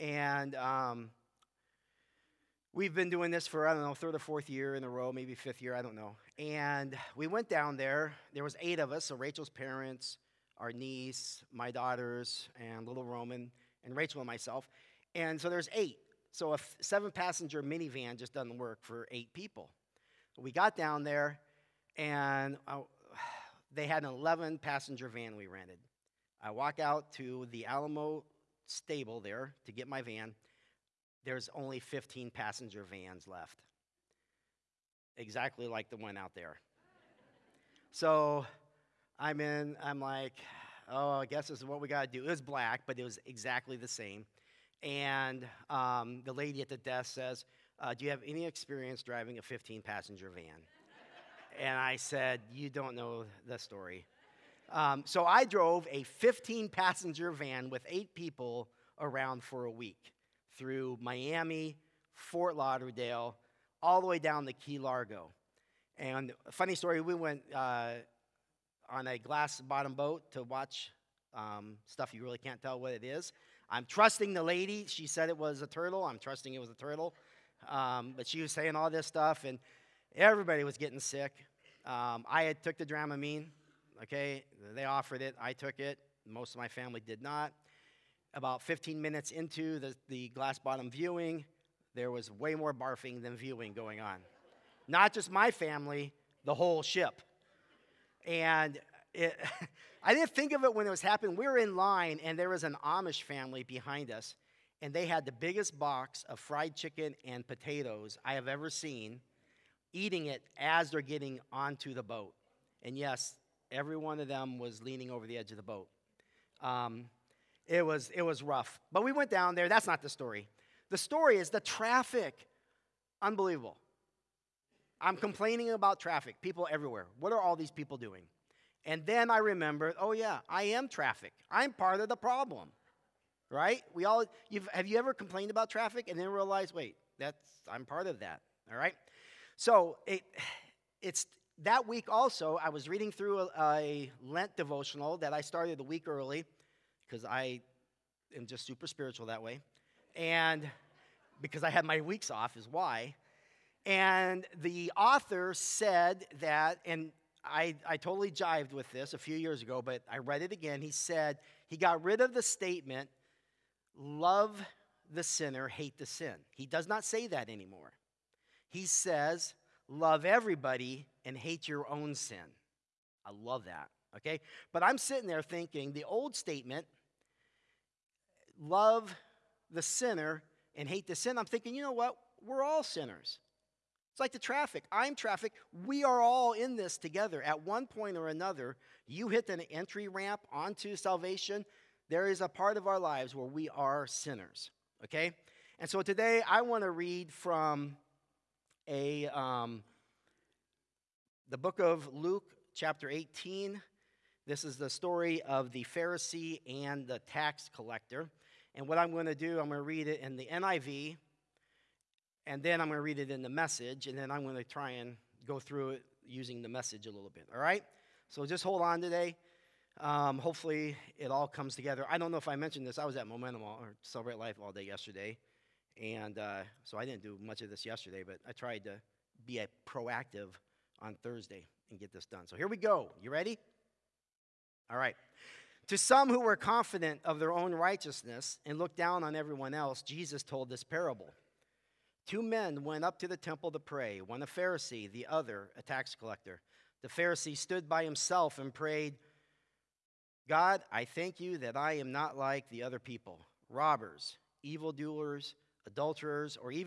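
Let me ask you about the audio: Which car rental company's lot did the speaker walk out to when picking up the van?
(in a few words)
Alamo.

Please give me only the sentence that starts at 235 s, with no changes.
To some who were confident of their own righteousness and looked down on everyone else, Jesus told this parable.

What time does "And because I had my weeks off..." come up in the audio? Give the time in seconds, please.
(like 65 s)
150 s.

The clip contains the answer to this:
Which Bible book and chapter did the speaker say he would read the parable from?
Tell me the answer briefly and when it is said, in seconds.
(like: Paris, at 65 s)
Luke 18, at 202 s.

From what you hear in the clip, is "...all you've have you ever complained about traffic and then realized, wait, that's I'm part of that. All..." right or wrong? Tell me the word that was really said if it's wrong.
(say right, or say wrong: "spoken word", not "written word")
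right.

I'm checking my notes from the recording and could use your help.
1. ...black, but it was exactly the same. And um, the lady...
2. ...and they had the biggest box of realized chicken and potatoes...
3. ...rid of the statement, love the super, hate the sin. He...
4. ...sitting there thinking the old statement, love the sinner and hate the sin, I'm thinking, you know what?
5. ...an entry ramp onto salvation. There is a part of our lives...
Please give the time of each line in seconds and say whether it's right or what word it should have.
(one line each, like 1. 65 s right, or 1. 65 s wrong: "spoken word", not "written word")
1. 42 s right
2. 104 s wrong: "fried", not "realized"
3. 162 s wrong: "sinner", not "super"
4. 174 s right
5. 189 s right.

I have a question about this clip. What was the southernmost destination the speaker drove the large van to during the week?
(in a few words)
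Key Largo.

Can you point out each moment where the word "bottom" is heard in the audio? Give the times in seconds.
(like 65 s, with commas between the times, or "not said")
69 s, 90 s.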